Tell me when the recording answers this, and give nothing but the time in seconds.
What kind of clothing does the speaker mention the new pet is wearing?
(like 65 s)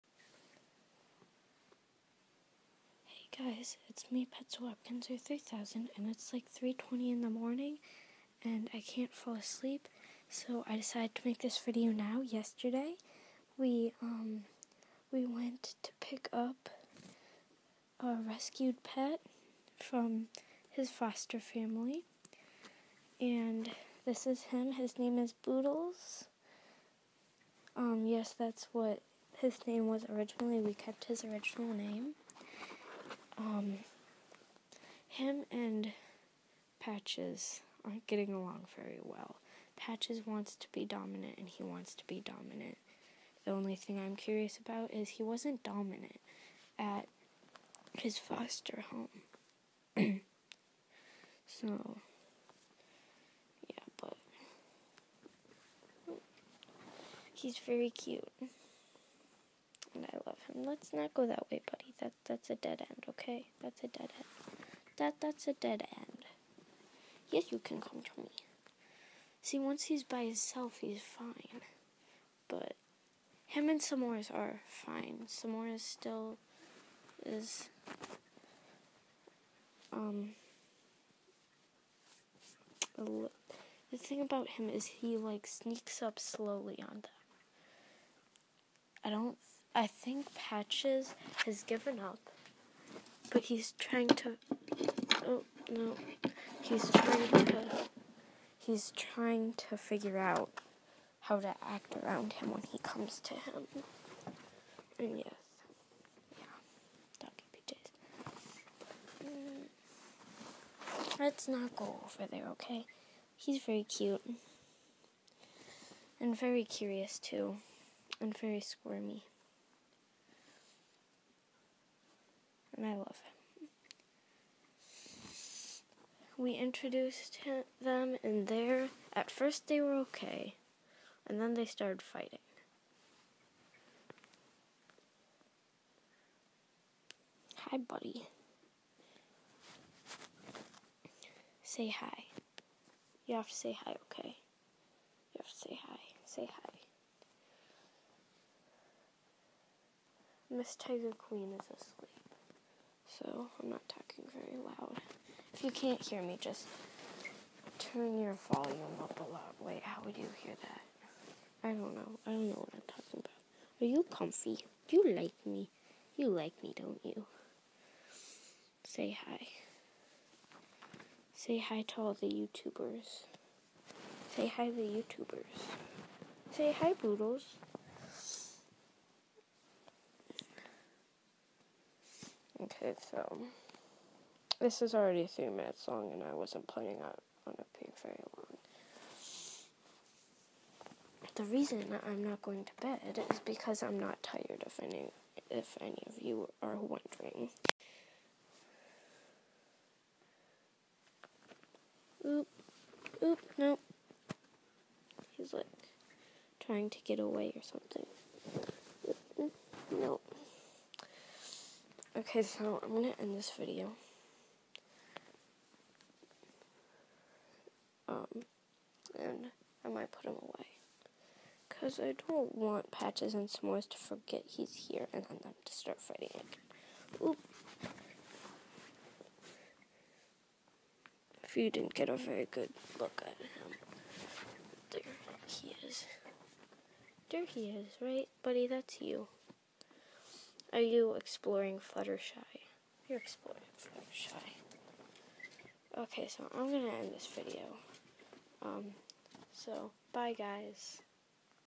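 107 s.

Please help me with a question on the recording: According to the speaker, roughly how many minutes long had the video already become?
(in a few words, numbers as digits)
3.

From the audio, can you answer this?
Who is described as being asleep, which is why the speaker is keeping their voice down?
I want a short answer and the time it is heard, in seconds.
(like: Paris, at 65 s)
Miss Tiger Queen, at 150 s.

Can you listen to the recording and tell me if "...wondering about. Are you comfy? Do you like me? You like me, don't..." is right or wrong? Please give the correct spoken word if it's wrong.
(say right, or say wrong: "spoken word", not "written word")
wrong: "talking", not "wondering".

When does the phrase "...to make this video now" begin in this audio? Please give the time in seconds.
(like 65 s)
11 s.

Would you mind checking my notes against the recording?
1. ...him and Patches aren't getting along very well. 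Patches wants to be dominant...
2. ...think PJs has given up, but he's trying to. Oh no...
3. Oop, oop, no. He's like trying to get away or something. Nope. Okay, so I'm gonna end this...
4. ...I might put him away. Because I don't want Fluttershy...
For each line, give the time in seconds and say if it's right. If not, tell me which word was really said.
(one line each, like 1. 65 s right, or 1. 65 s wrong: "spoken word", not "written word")
1. 35 s right
2. 89 s wrong: "Patches", not "PJs"
3. 202 s right
4. 219 s wrong: "Patches", not "Fluttershy".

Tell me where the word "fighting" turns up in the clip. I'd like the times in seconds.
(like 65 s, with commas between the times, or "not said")
132 s, 226 s.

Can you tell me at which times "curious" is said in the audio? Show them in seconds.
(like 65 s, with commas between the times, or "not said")
44 s, 116 s.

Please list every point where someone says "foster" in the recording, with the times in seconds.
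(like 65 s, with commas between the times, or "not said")
20 s, 48 s.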